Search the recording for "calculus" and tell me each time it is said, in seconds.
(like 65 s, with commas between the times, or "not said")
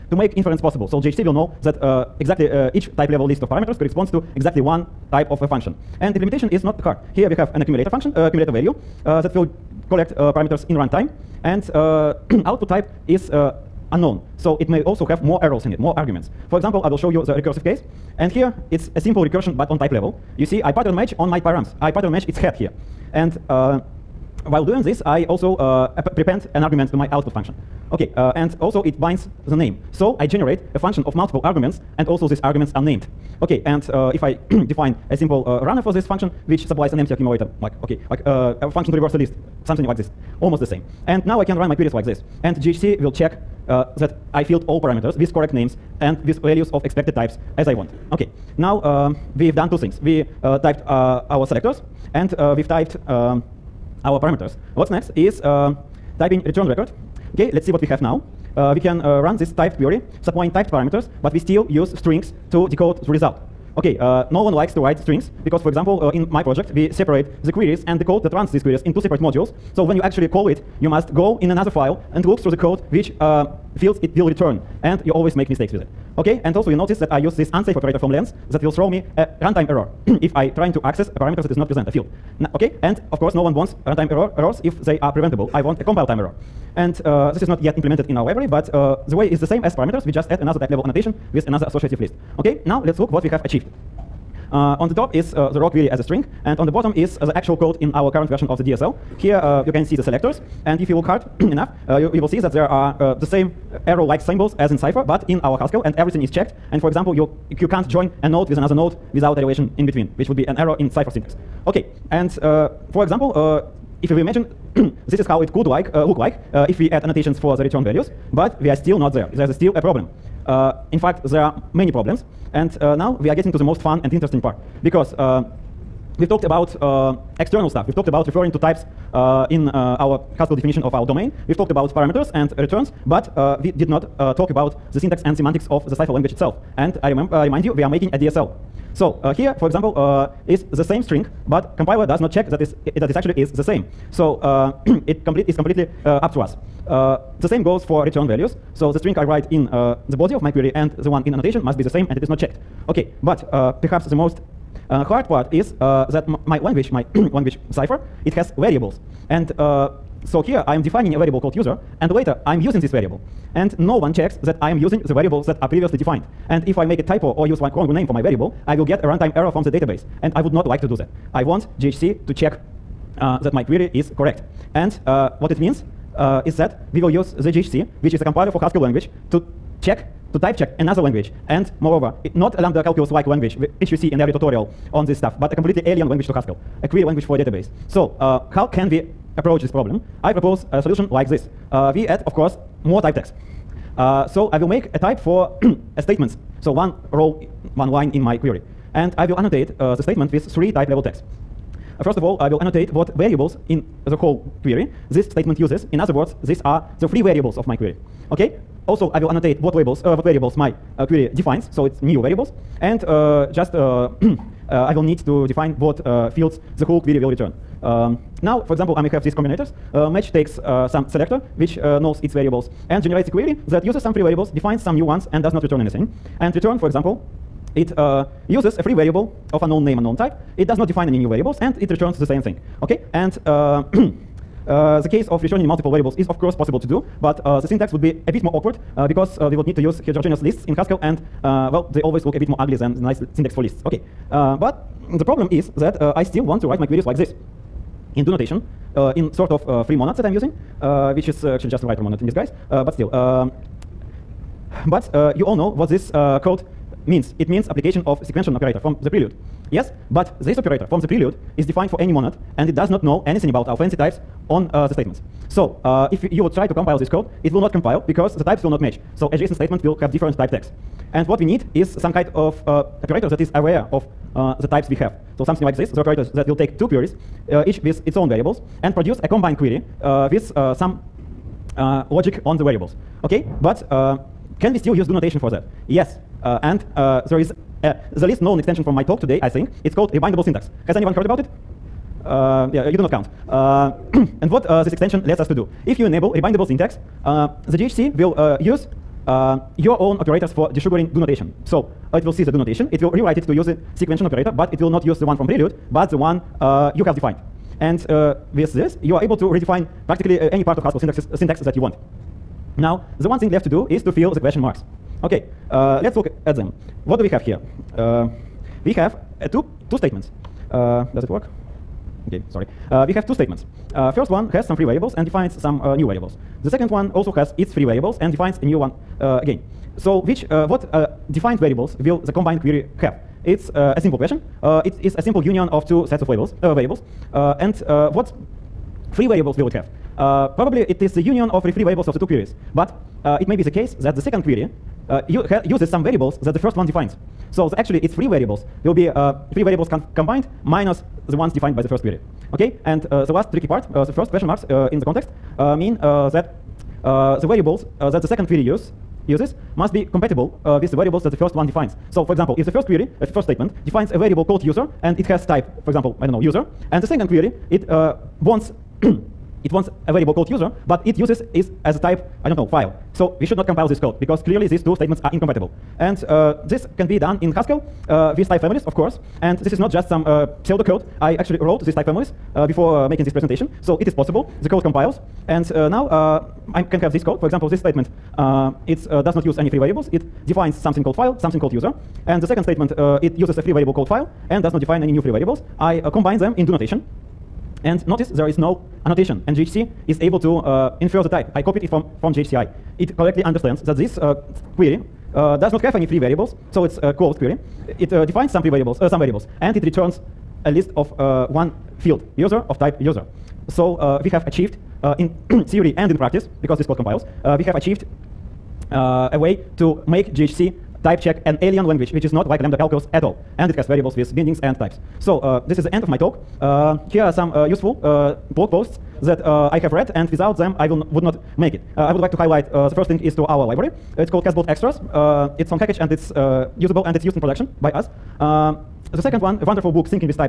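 182 s, 422 s.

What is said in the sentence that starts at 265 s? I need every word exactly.
So uh, if you would try to compile this code, it will not compile because the types will not match.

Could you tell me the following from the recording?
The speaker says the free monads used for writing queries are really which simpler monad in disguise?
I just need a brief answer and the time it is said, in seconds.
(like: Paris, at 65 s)
Writer monad, at 251 s.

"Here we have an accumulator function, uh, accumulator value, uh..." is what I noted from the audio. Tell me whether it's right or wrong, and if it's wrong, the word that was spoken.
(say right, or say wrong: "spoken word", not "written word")
right.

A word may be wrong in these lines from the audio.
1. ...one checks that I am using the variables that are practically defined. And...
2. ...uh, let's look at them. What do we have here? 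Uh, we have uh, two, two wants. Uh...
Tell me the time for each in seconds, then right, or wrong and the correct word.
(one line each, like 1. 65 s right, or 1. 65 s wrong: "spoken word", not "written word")
1. 163 s wrong: "previously", not "practically"
2. 315 s wrong: "statements", not "wants".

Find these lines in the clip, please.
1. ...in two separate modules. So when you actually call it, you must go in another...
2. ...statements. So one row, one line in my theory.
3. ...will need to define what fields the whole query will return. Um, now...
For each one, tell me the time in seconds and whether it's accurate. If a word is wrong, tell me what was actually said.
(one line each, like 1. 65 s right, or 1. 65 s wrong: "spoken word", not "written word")
1. 68 s right
2. 196 s wrong: "query", not "theory"
3. 214 s right.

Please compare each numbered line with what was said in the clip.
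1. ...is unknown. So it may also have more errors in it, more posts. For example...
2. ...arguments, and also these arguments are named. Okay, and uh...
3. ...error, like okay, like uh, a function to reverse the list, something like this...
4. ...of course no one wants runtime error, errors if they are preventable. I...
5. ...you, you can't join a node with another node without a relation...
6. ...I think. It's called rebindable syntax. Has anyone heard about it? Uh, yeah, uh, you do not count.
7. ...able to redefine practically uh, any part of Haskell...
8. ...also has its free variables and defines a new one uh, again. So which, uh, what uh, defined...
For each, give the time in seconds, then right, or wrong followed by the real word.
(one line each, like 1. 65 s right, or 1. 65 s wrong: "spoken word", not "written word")
1. 13 s wrong: "arguments", not "posts"
2. 31 s right
3. 37 s wrong: "accumulator", not "error"
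4. 83 s right
5. 107 s right
6. 289 s right
7. 309 s right
8. 327 s right.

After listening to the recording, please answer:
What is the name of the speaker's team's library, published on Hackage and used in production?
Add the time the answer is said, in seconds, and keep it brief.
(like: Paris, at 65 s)
Casbot Extras, at 434 s.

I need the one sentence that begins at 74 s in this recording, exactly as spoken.
And you always make mistakes with it.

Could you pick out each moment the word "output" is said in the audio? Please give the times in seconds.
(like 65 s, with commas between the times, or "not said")
12 s, 27 s.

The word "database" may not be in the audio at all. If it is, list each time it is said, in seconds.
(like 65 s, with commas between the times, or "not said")
169 s, 187 s.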